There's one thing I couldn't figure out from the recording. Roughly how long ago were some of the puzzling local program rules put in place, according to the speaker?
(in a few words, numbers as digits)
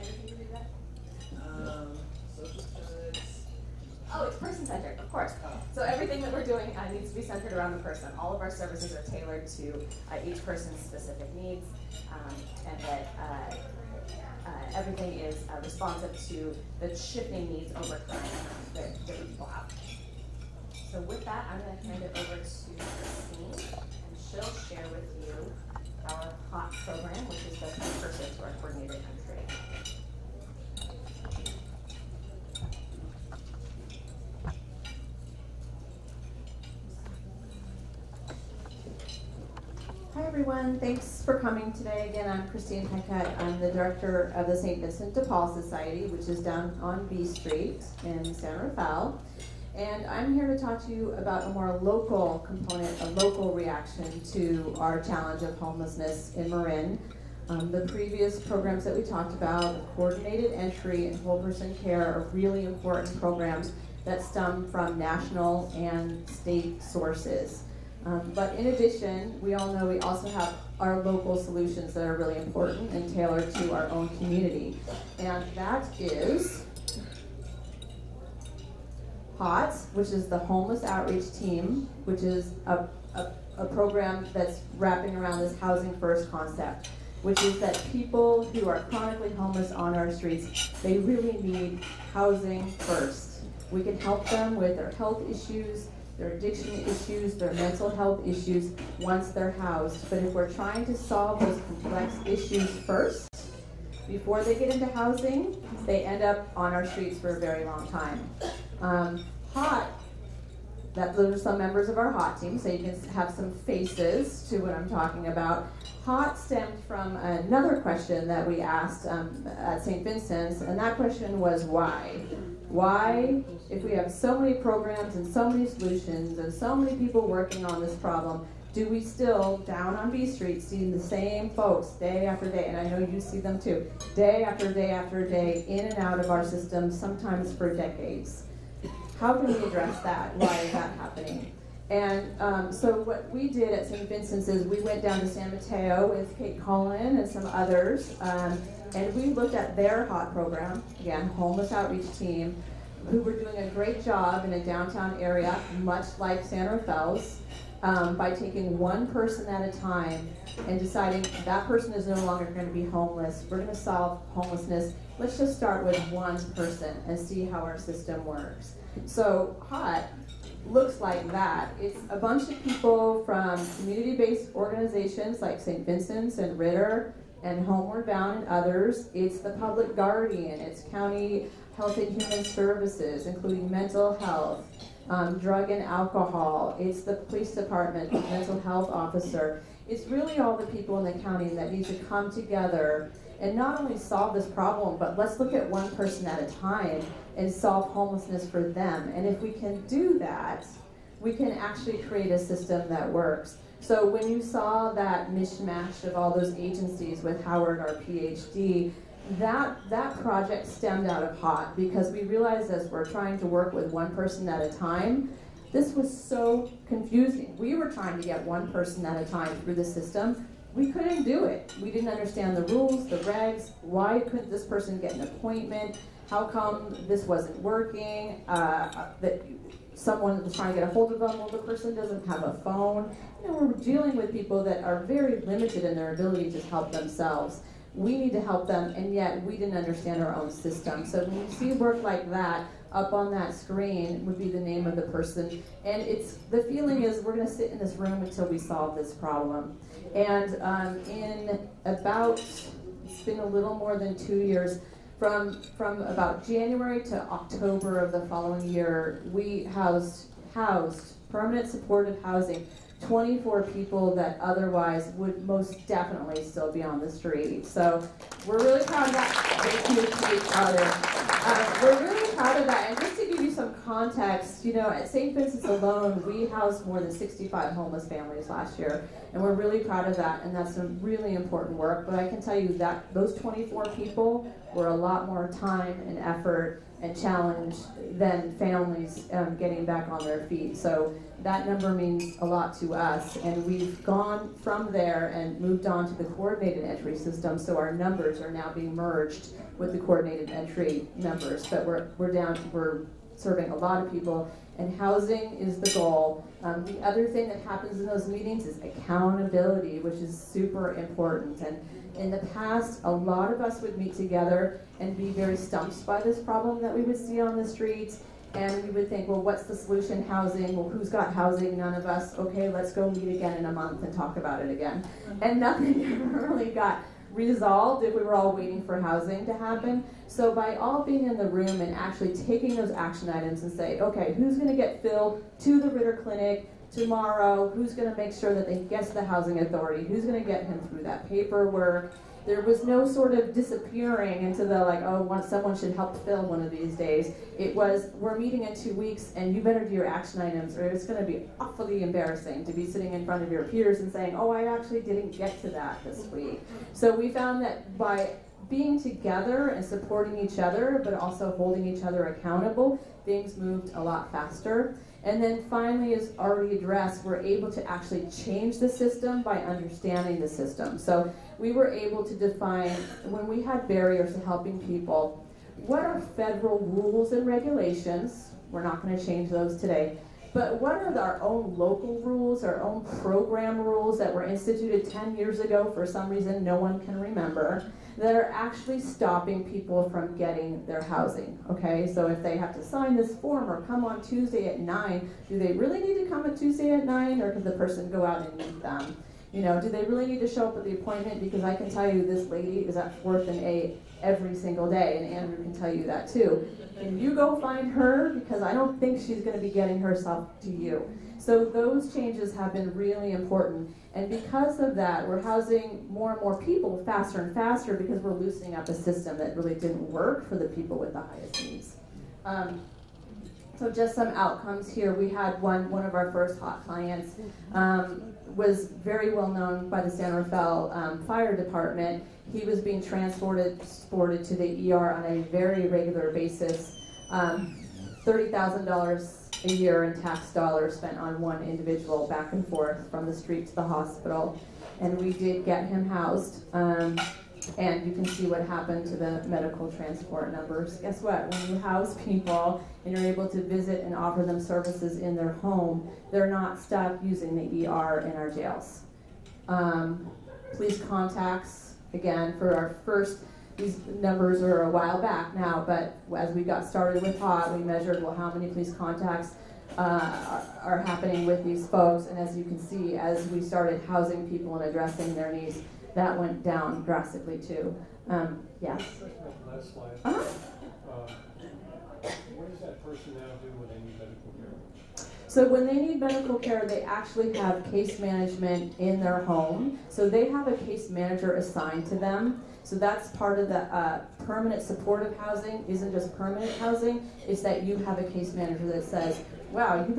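10 years ago.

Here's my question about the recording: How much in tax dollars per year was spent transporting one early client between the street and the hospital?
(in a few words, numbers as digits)
$30,000.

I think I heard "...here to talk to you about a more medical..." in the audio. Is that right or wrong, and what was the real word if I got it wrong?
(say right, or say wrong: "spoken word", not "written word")
wrong: "local", not "medical".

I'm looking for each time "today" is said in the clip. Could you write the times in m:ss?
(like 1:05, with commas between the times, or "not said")
0:41, 6:19.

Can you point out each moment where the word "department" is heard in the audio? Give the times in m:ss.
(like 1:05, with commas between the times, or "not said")
3:07, 7:11.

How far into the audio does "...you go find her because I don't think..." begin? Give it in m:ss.
6:47.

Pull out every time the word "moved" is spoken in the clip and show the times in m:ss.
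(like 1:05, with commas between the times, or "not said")
4:55, 6:03.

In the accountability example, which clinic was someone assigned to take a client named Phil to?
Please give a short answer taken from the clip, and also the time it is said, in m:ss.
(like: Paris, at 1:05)
Ritter Clinic, at 5:35.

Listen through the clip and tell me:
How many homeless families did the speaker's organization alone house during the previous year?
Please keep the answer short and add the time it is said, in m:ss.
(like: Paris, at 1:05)
more than 65, at 4:36.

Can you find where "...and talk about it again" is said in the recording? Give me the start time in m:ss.
5:24.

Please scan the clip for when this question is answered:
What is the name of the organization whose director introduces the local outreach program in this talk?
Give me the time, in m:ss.
0:44.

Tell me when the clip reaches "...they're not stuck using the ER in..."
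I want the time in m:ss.
7:36.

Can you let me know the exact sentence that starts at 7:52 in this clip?
And as you can see, as we started housing people and addressing their needs, that went down drastically too.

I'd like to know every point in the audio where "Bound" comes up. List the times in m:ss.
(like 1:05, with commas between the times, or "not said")
2:58.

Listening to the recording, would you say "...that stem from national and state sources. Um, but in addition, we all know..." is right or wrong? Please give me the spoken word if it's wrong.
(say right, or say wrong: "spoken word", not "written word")
right.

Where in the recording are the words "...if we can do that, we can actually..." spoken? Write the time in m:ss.
3:19.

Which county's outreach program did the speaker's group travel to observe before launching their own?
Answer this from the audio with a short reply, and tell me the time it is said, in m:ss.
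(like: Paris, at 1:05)
San Mateo, at 2:25.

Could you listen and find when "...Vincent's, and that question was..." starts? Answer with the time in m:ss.
2:00.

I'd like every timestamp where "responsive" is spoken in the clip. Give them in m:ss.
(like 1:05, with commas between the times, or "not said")
0:15.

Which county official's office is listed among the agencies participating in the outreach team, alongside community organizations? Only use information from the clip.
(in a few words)
Public Guardian.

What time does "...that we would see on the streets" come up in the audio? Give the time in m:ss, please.
5:16.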